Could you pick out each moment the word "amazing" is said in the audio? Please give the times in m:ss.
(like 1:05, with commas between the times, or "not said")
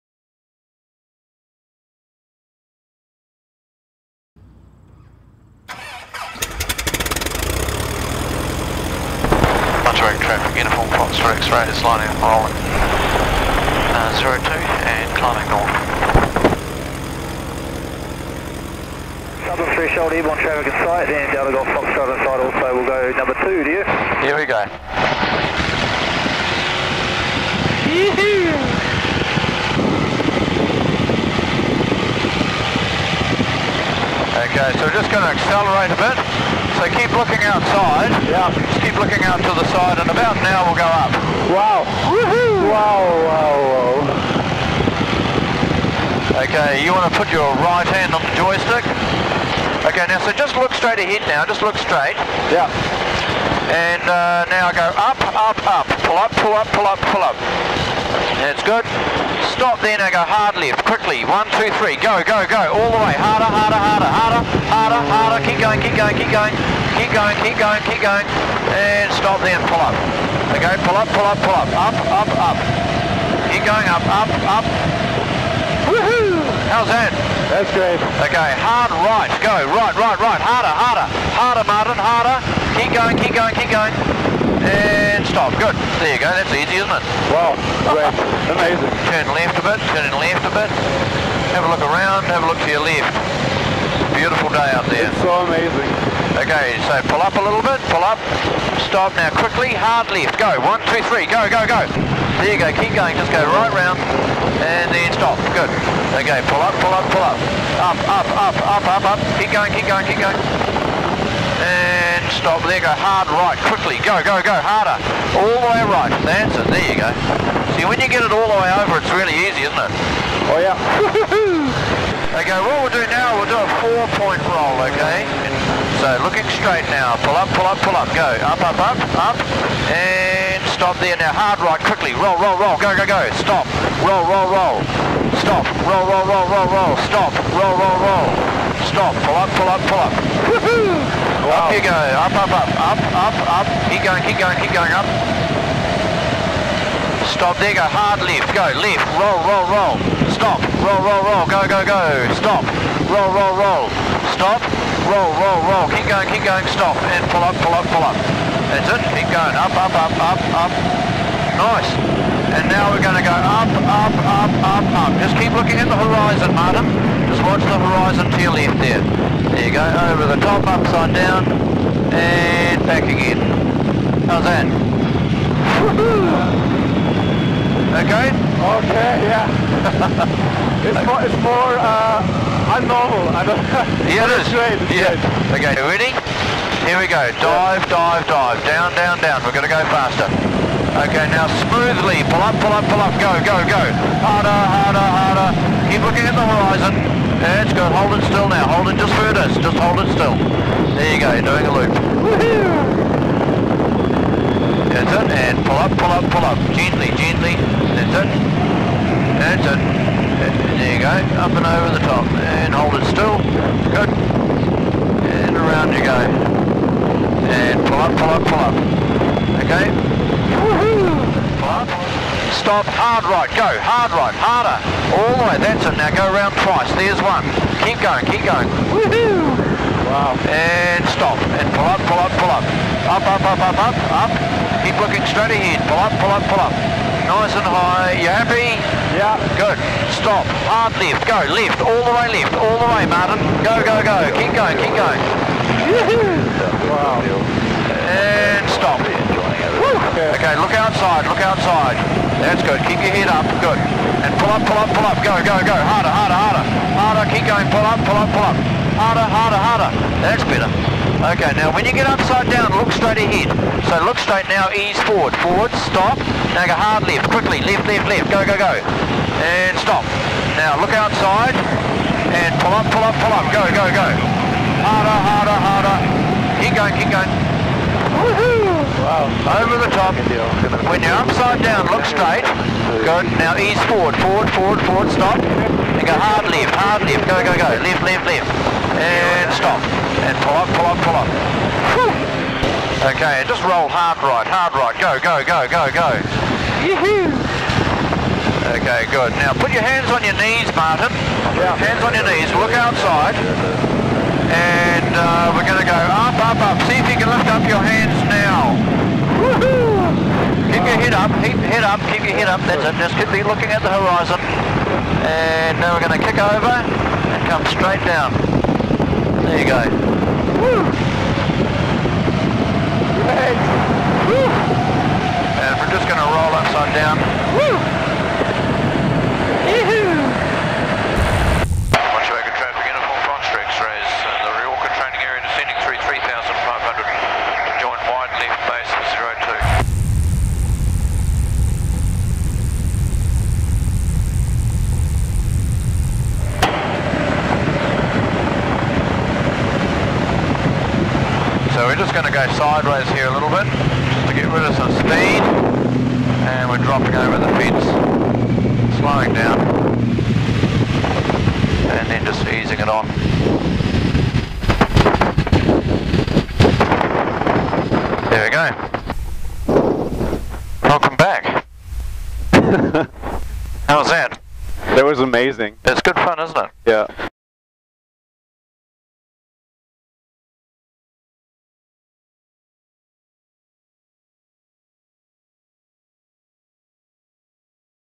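1:28, 1:35, 6:15.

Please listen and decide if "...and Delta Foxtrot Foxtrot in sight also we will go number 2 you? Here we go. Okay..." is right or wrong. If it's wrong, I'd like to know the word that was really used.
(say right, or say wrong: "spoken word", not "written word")
wrong: "Golf", not "Foxtrot".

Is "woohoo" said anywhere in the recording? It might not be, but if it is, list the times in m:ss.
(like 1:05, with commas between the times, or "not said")
0:42, 1:15, 2:20, 3:48, 4:05, 4:38.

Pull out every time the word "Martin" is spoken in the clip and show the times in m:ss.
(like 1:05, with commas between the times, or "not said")
1:21, 2:46, 4:03, 5:00.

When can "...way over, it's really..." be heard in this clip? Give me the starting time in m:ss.
1:58.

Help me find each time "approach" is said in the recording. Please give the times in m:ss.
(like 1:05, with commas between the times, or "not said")
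not said.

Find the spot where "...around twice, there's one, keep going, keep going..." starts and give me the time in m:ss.
3:46.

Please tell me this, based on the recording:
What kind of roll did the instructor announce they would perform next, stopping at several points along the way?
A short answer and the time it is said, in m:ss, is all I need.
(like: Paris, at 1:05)
Four-point roll, at 2:03.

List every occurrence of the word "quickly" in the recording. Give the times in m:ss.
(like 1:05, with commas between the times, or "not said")
1:00, 1:39, 1:53, 2:11, 4:27.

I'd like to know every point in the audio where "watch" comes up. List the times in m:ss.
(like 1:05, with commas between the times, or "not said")
2:47.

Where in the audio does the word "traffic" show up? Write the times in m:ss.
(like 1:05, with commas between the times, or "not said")
0:10, 0:20.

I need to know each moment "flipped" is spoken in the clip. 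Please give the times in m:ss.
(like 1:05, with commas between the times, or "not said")
not said.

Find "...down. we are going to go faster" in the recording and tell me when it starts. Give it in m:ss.
3:09.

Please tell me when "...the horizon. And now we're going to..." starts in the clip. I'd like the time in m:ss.
5:13.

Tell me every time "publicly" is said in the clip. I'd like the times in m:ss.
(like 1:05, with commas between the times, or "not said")
not said.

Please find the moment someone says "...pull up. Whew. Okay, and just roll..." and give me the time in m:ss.
4:51.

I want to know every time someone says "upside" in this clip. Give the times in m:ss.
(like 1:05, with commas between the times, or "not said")
2:50, 4:22, 4:41, 5:26.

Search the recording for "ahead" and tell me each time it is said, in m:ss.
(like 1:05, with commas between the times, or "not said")
0:50, 3:55, 4:23.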